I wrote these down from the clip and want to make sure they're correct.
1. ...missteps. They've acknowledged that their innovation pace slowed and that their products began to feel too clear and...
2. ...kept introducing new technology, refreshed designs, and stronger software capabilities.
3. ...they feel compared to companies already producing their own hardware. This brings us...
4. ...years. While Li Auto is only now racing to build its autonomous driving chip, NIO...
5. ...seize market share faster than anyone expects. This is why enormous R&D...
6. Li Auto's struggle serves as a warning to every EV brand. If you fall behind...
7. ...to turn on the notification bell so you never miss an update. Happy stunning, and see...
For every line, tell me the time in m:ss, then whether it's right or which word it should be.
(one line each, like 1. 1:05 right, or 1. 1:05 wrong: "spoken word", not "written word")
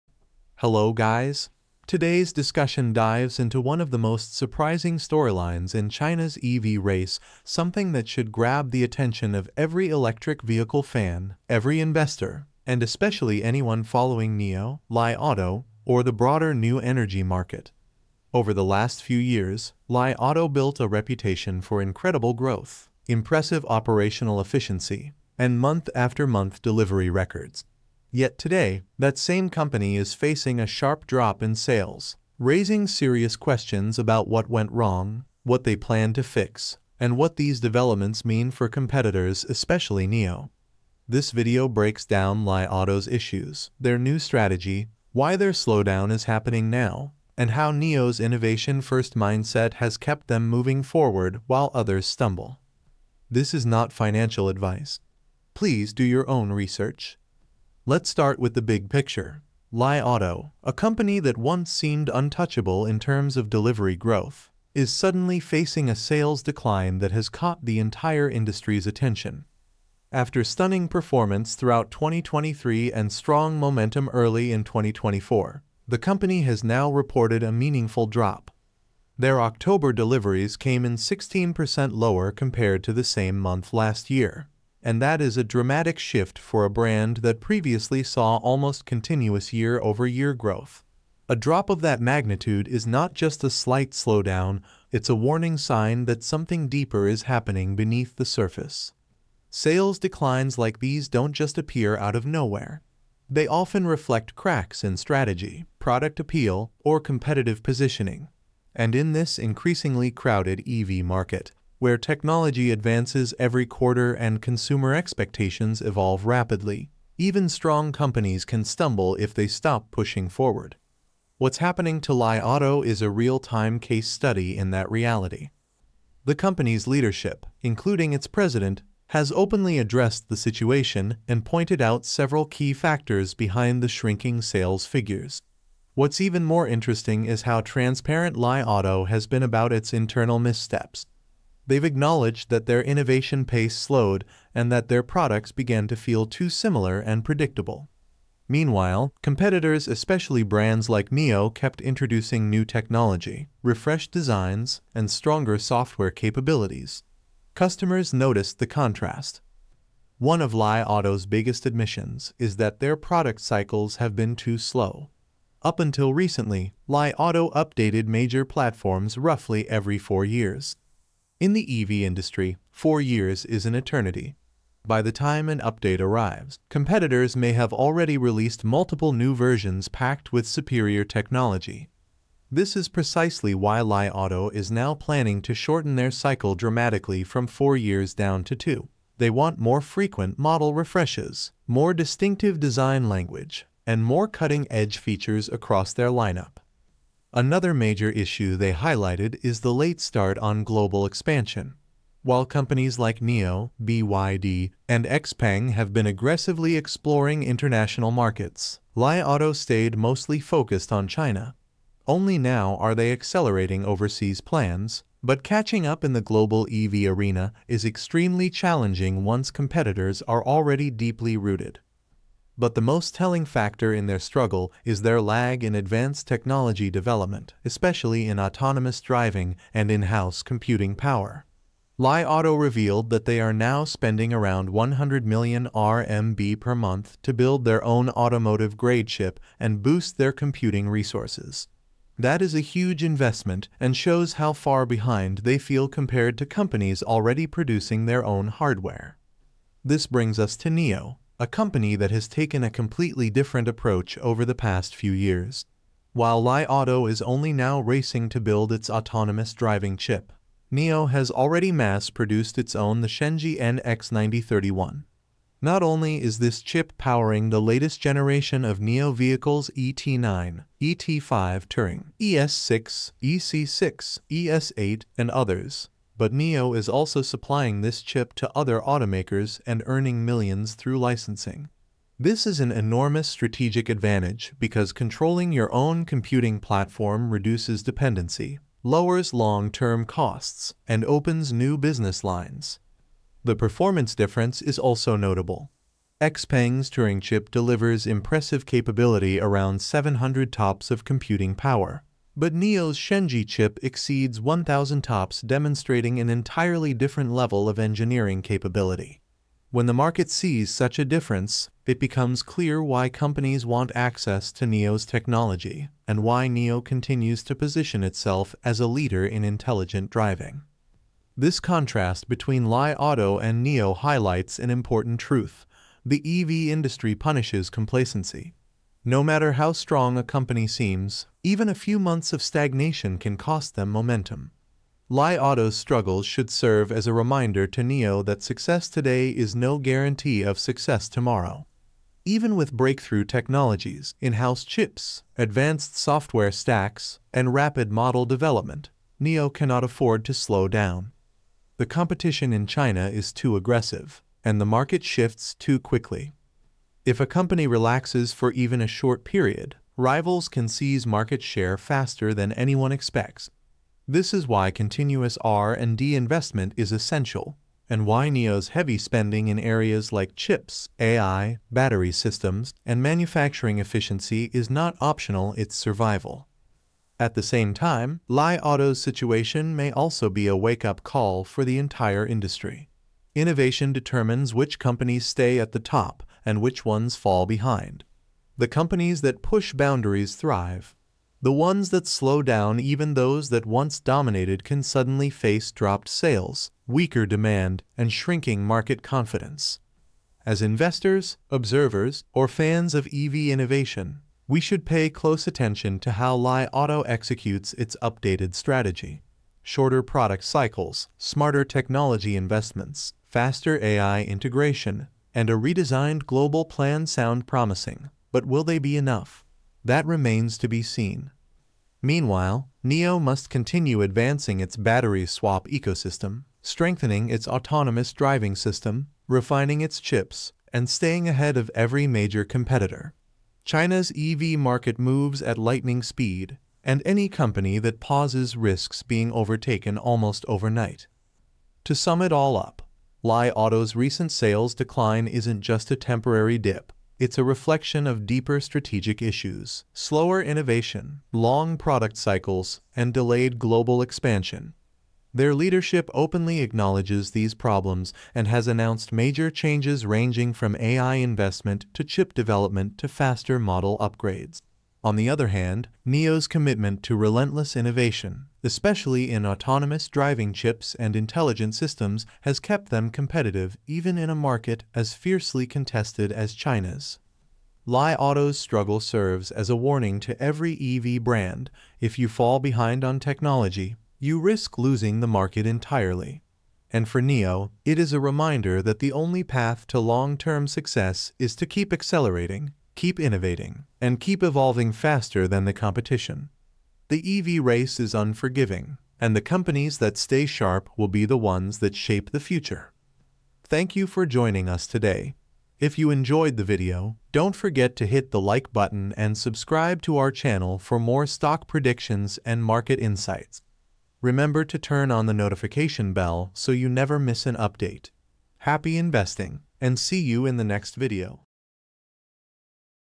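1. 2:20 wrong: "similar", not "clear"
2. 2:31 right
3. 4:05 right
4. 4:15 right
5. 6:00 wrong: "continuous", not "enormous"
6. 7:57 right
7. 8:34 wrong: "investing", not "stunning".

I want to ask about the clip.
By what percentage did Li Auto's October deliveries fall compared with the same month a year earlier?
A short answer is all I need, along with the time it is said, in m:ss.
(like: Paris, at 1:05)
16%, at 1:20.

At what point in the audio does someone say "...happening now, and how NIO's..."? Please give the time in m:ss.
0:46.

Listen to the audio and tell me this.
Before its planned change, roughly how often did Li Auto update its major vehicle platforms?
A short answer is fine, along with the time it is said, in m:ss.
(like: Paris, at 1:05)
every 4 years, at 2:49.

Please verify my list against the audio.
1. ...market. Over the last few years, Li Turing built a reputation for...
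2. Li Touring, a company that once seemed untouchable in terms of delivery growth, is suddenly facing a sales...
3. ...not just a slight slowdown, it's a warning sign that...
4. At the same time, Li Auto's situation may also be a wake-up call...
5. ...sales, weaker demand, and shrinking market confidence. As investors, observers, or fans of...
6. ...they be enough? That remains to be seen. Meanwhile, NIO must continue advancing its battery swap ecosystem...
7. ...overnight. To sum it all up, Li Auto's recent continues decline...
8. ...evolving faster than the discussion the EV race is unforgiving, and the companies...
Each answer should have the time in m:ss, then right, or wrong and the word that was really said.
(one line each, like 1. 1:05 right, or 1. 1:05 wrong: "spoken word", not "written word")
1. 0:17 wrong: "Auto", not "Turing"
2. 0:59 wrong: "Auto", not "Touring"
3. 1:32 right
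4. 6:17 right
5. 6:36 right
6. 6:58 right
7. 7:20 wrong: "sales", not "continues"
8. 8:14 wrong: "competition", not "discussion".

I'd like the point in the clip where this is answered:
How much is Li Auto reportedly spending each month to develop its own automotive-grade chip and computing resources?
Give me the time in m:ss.
3:54.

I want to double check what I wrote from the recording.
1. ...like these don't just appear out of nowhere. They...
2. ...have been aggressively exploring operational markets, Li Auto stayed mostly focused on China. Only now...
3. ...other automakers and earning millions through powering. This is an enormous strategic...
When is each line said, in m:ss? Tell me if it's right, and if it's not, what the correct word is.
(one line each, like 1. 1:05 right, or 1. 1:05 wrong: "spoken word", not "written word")
1. 1:40 right
2. 3:25 wrong: "international", not "operational"
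3. 4:38 wrong: "licensing", not "powering".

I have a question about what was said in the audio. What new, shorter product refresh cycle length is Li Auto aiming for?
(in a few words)
2 years.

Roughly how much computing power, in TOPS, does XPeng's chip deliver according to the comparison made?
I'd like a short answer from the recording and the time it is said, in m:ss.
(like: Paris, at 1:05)
700 TOPS, at 4:59.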